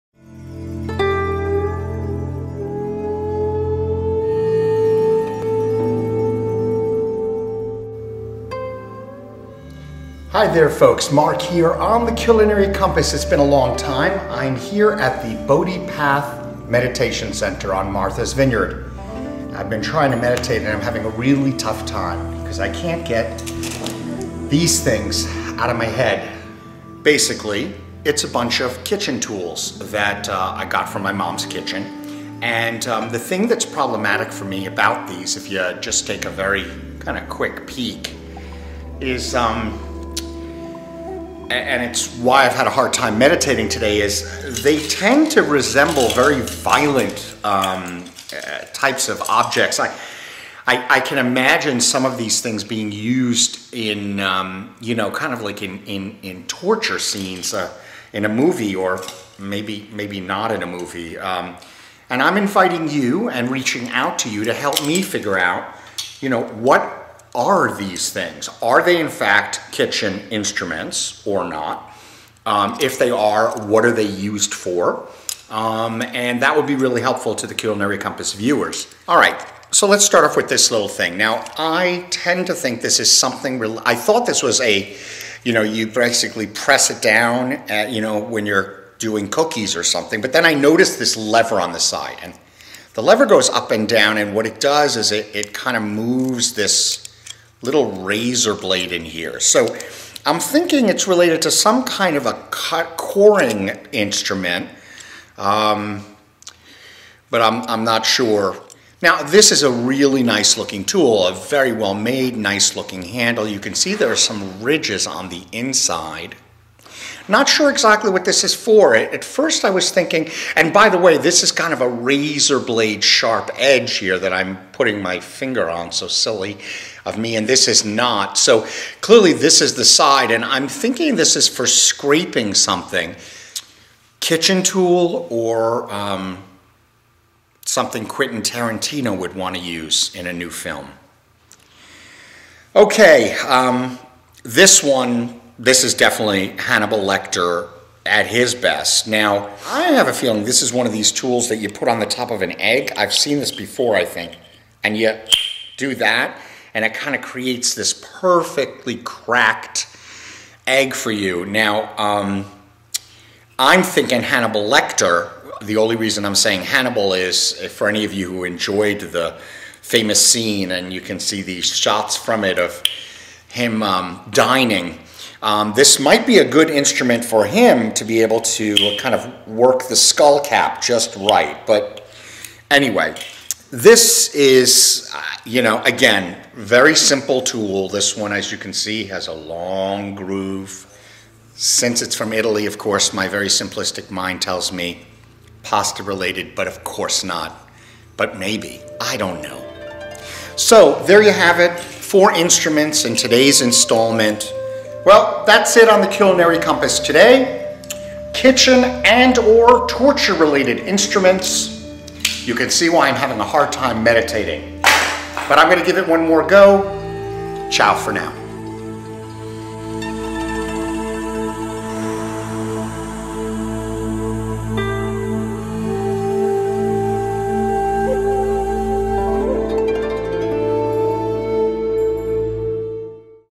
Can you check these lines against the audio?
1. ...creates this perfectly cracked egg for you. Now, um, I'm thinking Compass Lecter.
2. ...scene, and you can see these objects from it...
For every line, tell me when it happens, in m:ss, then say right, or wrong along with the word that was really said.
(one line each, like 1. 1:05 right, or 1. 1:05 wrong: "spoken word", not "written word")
1. 2:37 wrong: "Hannibal", not "Compass"
2. 2:50 wrong: "shots", not "objects".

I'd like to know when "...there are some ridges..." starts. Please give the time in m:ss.
1:53.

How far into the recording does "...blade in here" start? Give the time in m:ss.
1:38.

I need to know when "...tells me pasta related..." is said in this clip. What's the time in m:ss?
3:14.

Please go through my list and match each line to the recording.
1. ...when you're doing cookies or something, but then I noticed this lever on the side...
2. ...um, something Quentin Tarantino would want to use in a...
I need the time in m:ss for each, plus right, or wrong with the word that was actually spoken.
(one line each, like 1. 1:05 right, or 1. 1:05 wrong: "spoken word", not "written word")
1. 1:28 right
2. 2:15 right.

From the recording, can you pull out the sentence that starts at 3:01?
But anyway, this is, uh, you know, again, very simple tool.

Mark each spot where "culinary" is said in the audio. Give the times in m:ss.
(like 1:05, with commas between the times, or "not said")
0:12, 1:17, 3:26.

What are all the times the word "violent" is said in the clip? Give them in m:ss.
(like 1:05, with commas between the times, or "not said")
0:46.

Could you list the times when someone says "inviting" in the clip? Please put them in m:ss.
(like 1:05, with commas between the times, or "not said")
1:02.